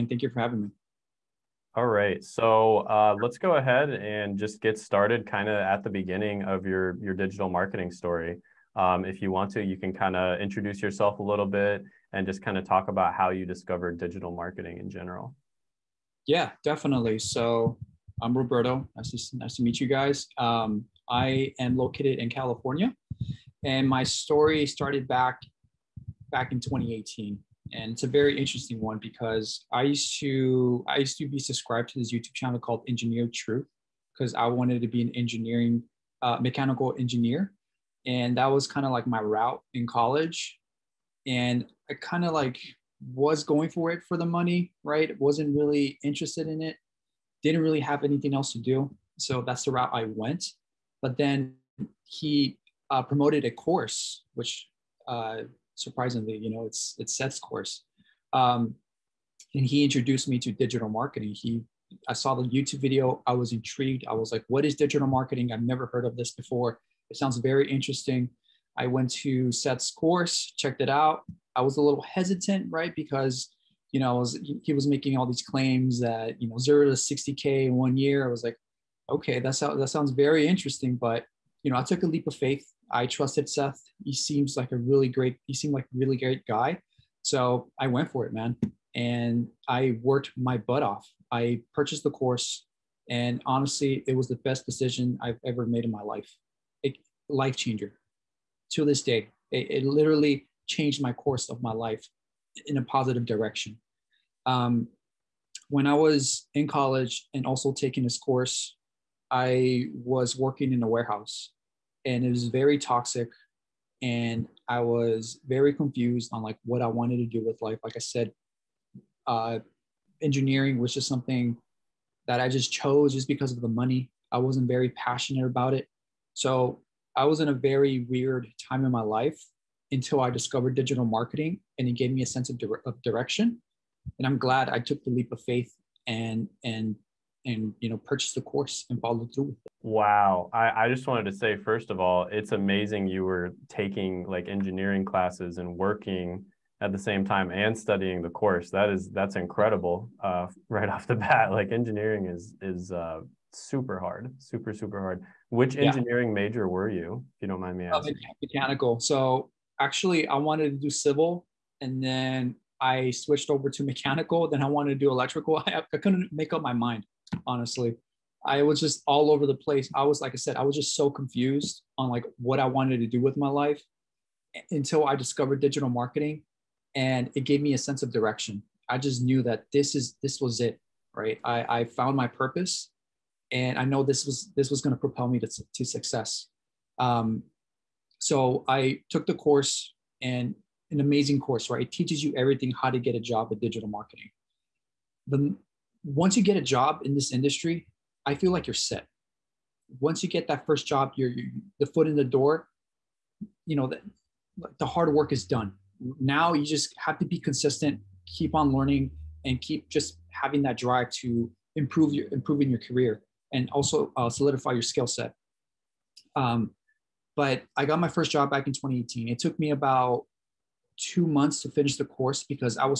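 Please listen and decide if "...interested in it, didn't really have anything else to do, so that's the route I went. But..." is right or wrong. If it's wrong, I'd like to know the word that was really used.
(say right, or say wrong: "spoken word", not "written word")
right.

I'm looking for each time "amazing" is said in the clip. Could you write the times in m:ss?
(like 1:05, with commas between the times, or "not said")
2:22, 3:10.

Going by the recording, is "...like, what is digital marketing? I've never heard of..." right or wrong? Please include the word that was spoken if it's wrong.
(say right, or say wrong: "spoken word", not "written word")
right.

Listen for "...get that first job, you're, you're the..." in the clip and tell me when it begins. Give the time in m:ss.
3:20.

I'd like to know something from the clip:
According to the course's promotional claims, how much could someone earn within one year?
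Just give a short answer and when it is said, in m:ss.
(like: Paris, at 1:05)
60K, at 1:16.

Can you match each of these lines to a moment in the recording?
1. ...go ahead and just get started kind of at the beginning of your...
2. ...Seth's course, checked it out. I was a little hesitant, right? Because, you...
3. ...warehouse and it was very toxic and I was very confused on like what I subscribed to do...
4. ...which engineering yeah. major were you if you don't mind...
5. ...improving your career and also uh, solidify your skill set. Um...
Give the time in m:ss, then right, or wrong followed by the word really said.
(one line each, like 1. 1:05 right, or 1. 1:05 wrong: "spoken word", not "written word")
1. 0:03 right
2. 1:09 right
3. 1:50 wrong: "wanted", not "subscribed"
4. 2:35 right
5. 3:32 right.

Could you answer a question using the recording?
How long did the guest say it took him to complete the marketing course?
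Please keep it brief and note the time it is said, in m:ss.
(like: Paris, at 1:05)
about two months, at 3:39.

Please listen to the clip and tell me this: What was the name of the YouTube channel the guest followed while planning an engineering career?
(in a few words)
Engineer Truth.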